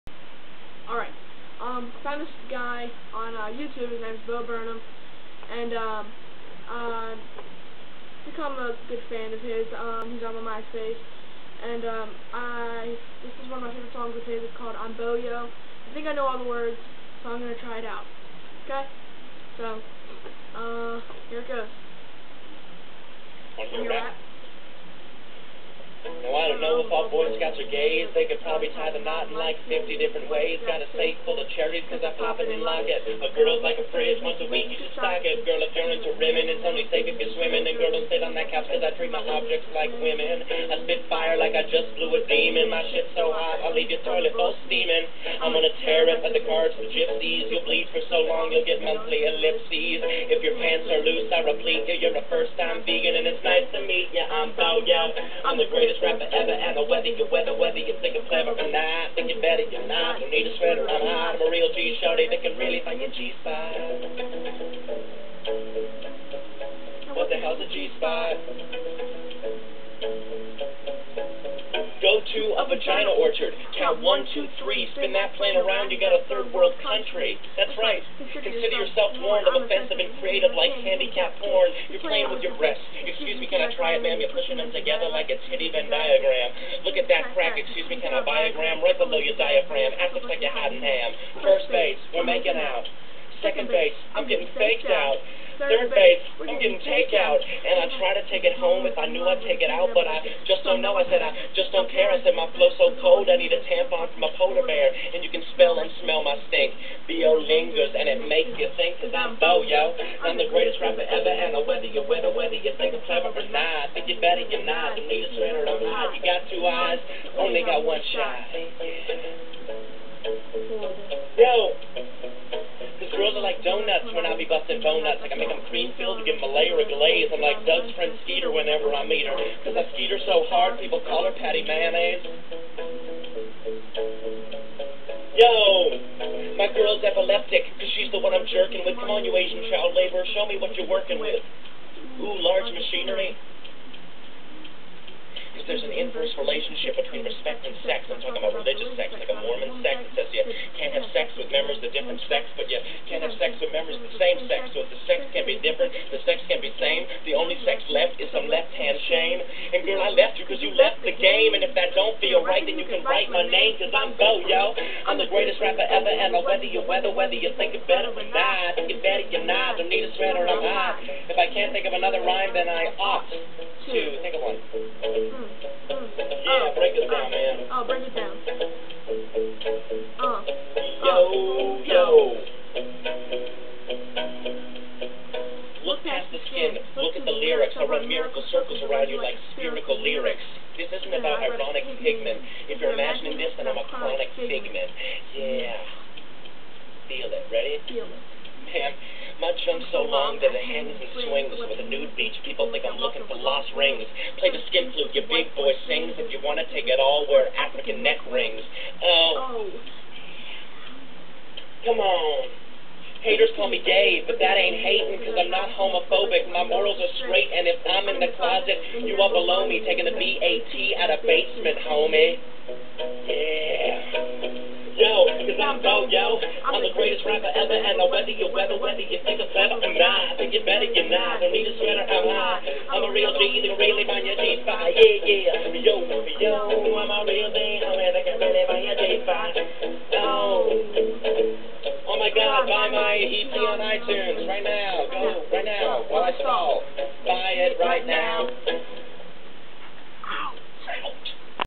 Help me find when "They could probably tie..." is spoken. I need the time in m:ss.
0:28.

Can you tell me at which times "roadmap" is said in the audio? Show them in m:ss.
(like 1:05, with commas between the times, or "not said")
not said.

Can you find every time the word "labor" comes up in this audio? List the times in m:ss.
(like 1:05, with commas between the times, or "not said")
2:19.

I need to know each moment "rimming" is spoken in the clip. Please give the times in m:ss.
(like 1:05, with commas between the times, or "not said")
0:36.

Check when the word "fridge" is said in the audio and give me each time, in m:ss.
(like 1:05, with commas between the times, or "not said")
0:33.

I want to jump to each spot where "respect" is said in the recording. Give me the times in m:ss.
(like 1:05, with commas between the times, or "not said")
2:27.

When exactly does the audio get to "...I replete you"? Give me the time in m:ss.
0:51.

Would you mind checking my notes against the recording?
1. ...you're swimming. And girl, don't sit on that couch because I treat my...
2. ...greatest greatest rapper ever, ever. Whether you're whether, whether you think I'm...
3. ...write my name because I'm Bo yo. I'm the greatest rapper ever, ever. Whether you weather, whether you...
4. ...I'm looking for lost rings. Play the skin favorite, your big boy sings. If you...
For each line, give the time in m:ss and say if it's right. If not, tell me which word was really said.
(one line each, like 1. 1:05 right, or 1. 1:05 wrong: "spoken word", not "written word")
1. 0:37 right
2. 0:55 right
3. 2:43 right
4. 3:22 wrong: "flute", not "favorite".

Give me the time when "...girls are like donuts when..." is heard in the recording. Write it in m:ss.
2:03.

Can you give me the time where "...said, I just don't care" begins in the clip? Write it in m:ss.
1:41.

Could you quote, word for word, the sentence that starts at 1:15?
You got a third world country.